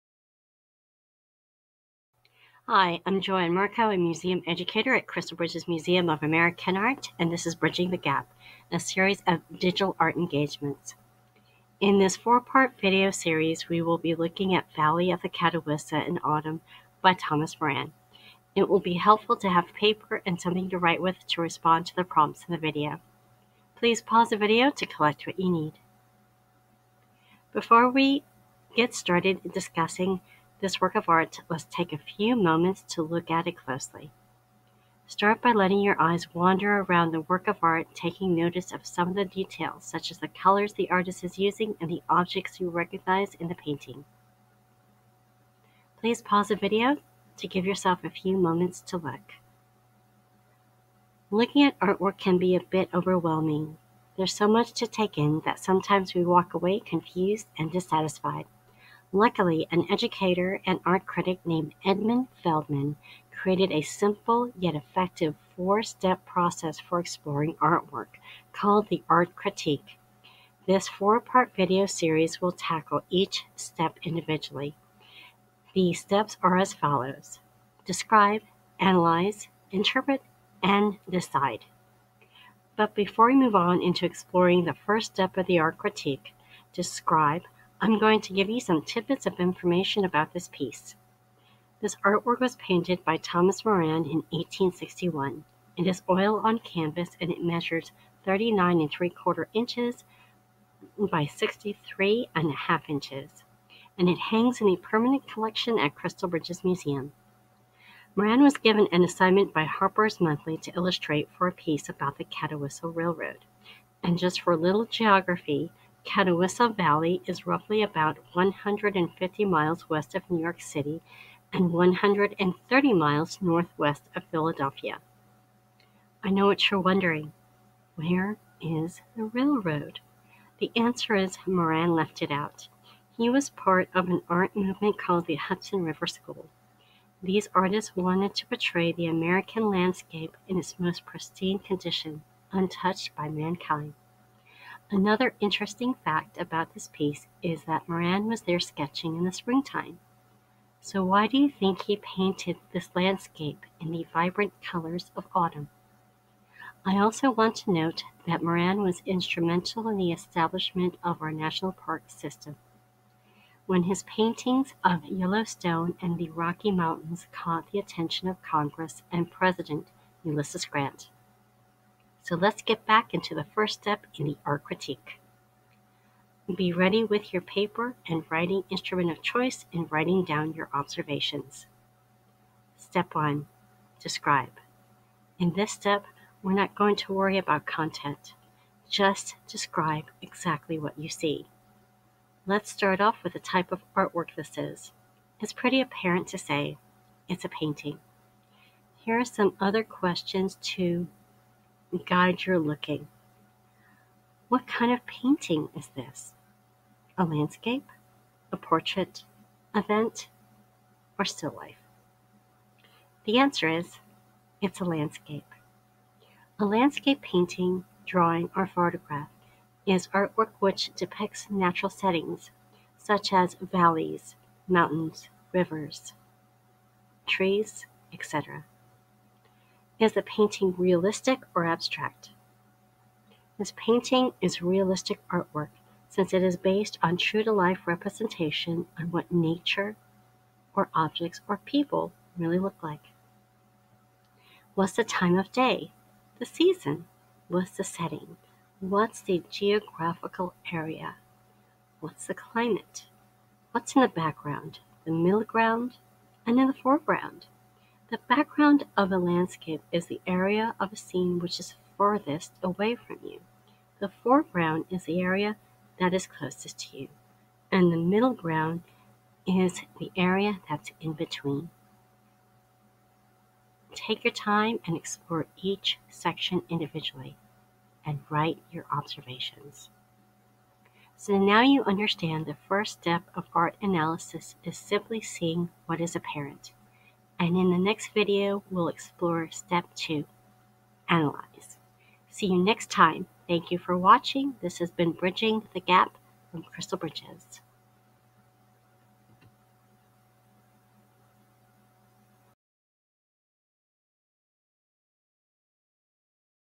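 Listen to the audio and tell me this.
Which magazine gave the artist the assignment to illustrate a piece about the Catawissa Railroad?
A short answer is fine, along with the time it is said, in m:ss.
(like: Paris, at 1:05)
Harper's Monthly, at 1:49.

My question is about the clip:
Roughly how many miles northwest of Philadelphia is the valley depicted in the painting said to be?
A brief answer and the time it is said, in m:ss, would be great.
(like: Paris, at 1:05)
130 miles, at 2:01.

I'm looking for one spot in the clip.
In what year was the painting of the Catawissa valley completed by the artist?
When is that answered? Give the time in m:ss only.
1:34.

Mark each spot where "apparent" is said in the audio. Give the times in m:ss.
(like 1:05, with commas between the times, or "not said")
3:15, 4:46.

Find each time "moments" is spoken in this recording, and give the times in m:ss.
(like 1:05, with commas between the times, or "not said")
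0:32, 0:48.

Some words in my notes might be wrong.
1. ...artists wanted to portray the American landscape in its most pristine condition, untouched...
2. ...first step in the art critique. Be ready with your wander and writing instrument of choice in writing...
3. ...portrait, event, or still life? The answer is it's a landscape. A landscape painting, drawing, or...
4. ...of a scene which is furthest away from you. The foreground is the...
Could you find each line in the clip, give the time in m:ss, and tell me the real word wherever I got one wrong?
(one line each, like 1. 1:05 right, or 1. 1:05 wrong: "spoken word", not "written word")
1. 2:17 right
2. 2:53 wrong: "paper", not "wander"
3. 3:28 right
4. 4:20 right.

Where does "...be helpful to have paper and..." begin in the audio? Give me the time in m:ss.
0:18.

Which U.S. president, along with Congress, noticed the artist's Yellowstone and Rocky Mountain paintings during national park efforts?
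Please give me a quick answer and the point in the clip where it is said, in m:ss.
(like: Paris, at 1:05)
Ulysses Grant, at 2:50.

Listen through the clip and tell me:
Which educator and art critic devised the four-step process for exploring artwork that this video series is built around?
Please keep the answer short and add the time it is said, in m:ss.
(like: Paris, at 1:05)
Edmund Feldman, at 1:01.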